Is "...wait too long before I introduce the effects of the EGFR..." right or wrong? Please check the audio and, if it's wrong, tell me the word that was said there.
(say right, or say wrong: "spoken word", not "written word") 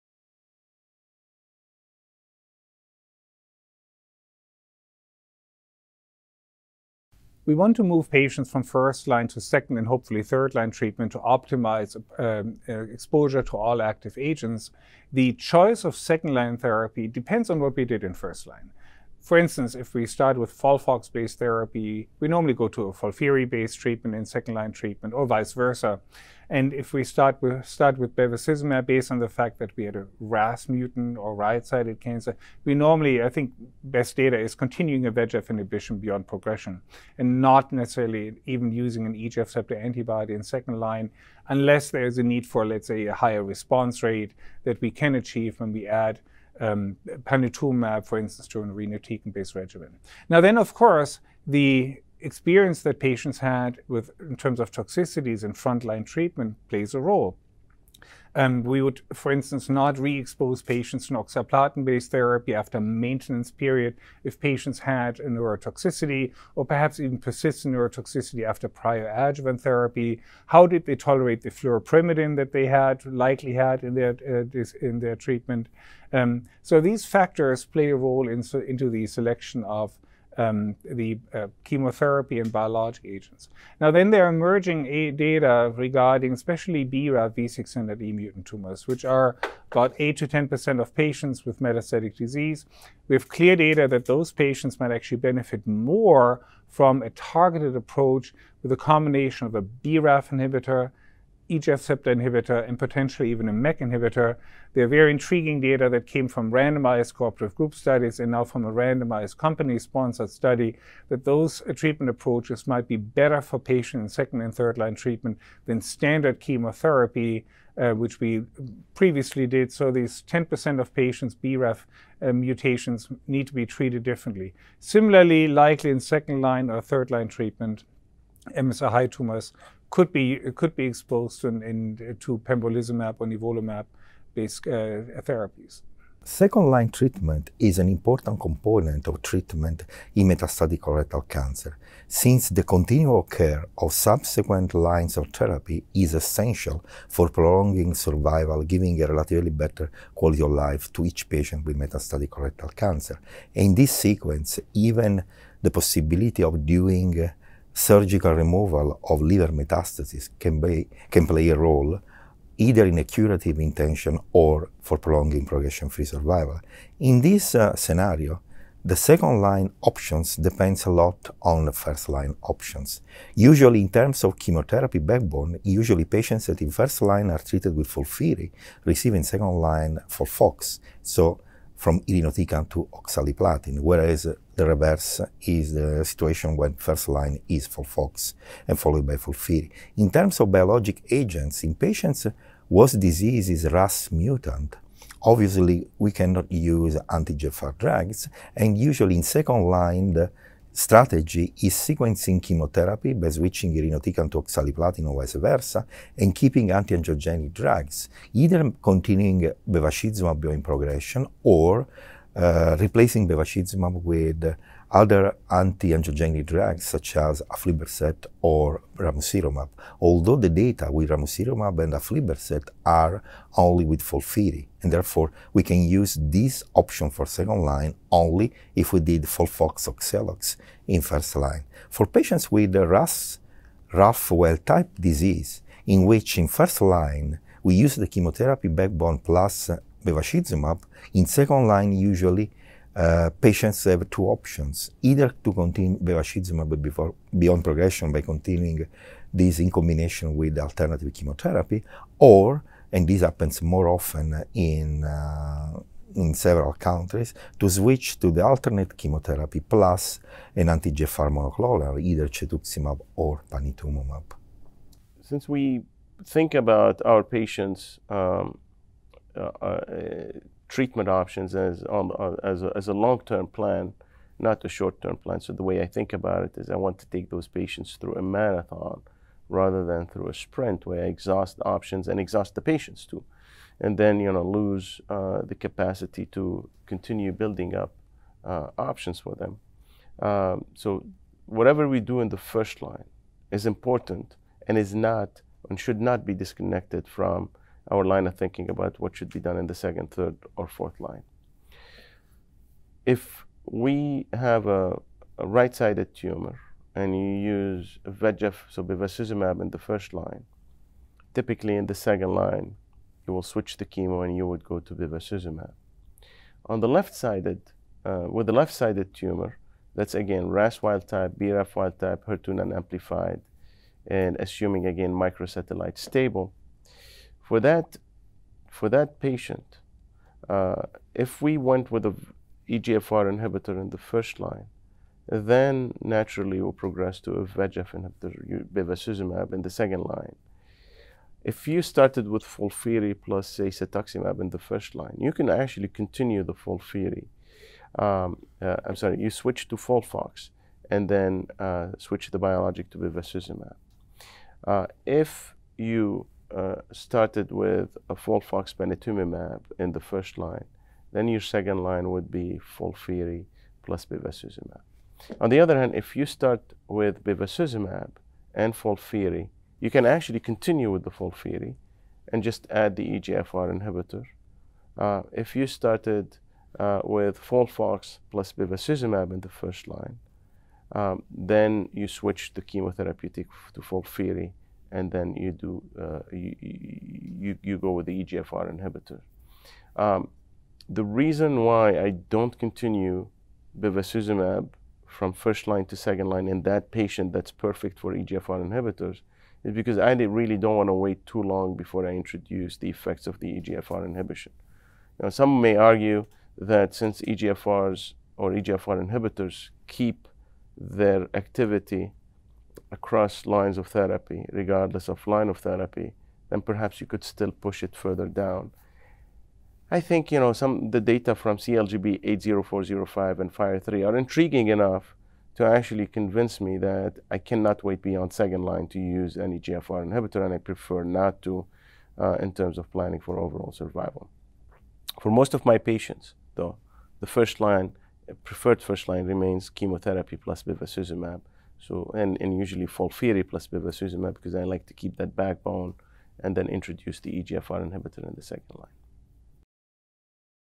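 right.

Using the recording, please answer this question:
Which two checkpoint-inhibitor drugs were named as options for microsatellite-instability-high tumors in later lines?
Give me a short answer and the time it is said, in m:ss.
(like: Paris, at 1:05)
pembrolizumab or nivolumab, at 2:12.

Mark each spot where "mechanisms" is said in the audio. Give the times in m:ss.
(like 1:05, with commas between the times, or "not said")
not said.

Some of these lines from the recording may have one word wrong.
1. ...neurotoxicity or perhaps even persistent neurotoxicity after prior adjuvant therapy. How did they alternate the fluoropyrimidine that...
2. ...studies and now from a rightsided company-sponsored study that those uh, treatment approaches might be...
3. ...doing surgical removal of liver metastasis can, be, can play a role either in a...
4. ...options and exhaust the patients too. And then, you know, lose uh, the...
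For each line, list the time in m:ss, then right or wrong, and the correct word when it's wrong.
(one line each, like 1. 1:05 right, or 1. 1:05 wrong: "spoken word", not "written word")
1. 1:05 wrong: "tolerate", not "alternate"
2. 1:47 wrong: "randomized", not "rightsided"
3. 2:36 right
4. 4:41 right.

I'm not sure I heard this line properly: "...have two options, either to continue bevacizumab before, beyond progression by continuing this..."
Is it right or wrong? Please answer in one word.
right.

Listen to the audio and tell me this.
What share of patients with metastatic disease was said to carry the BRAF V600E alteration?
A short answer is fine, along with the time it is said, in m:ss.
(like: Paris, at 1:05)
8 to 10%, at 1:29.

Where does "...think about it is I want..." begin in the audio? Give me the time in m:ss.
4:35.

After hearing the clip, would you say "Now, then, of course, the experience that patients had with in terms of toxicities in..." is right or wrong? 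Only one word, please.
right.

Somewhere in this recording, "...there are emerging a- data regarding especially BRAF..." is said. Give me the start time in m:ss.
1:24.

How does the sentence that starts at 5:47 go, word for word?
Um, uh, I'm sorry, you switch to FOLFOX and then uh, switch the biologic to bevacizumab.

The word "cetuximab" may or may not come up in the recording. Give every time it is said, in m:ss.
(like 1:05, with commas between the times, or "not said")
4:22, 5:43.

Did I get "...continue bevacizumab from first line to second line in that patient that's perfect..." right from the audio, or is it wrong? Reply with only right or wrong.
right.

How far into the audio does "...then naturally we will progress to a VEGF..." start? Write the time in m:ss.
5:35.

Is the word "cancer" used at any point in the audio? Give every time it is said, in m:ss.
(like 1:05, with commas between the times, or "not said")
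0:32, 2:21, 2:32.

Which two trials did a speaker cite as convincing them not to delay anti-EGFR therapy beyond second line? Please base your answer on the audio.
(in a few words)
CALGB 80405 and FIRE3.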